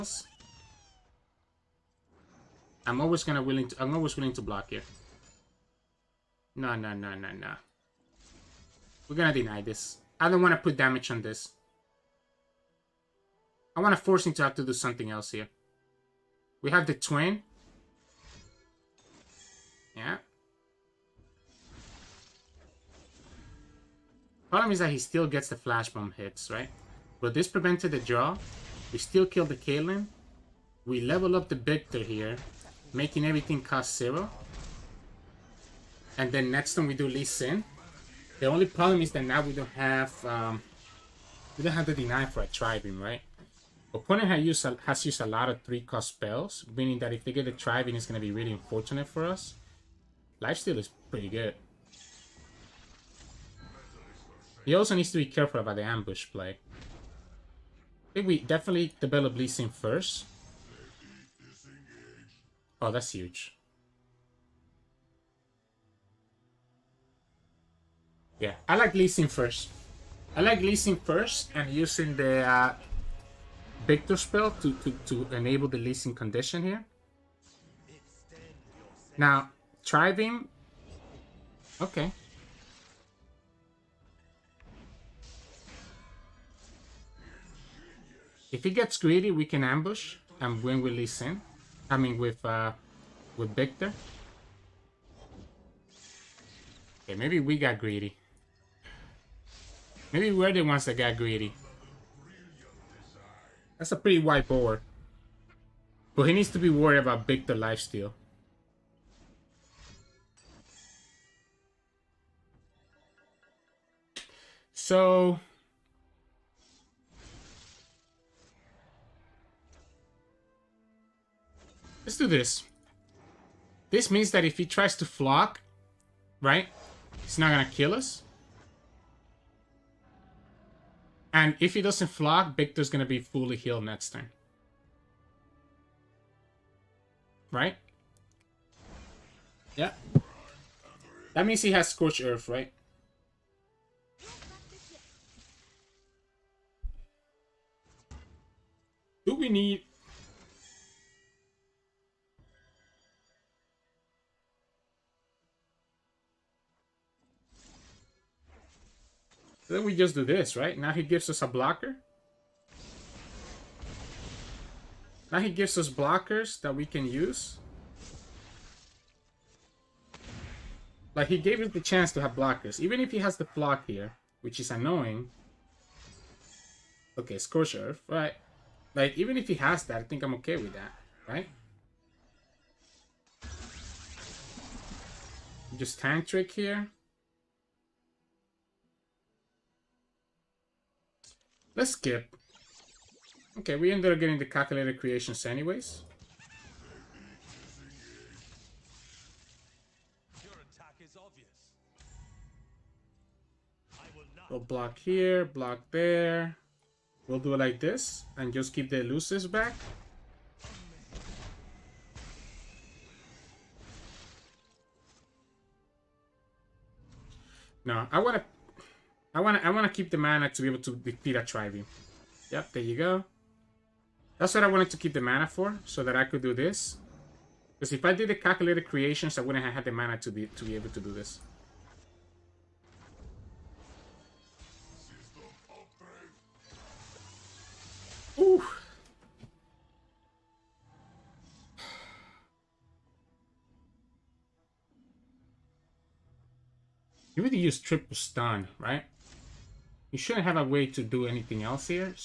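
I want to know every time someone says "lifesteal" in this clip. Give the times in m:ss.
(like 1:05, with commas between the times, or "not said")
0:50, 1:47.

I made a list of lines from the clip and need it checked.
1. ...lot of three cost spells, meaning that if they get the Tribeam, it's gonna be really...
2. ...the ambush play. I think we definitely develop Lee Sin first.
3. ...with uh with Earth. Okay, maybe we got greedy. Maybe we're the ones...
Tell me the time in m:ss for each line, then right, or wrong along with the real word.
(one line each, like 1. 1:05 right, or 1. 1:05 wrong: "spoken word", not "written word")
1. 0:45 right
2. 0:55 right
3. 1:32 wrong: "Viktor", not "Earth".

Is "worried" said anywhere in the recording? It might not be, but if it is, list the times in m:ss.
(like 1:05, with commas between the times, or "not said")
1:46.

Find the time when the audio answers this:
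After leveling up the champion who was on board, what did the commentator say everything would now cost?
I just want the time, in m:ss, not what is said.
0:33.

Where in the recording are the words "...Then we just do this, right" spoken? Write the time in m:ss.
2:39.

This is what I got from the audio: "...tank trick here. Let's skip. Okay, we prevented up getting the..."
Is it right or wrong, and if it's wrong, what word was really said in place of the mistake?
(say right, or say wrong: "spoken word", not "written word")
wrong: "ended", not "prevented".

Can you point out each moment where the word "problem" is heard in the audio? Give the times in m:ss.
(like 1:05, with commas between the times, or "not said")
0:24, 0:38.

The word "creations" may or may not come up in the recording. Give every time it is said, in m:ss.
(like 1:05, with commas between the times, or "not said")
3:14, 3:48.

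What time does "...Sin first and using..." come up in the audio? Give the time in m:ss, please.
1:10.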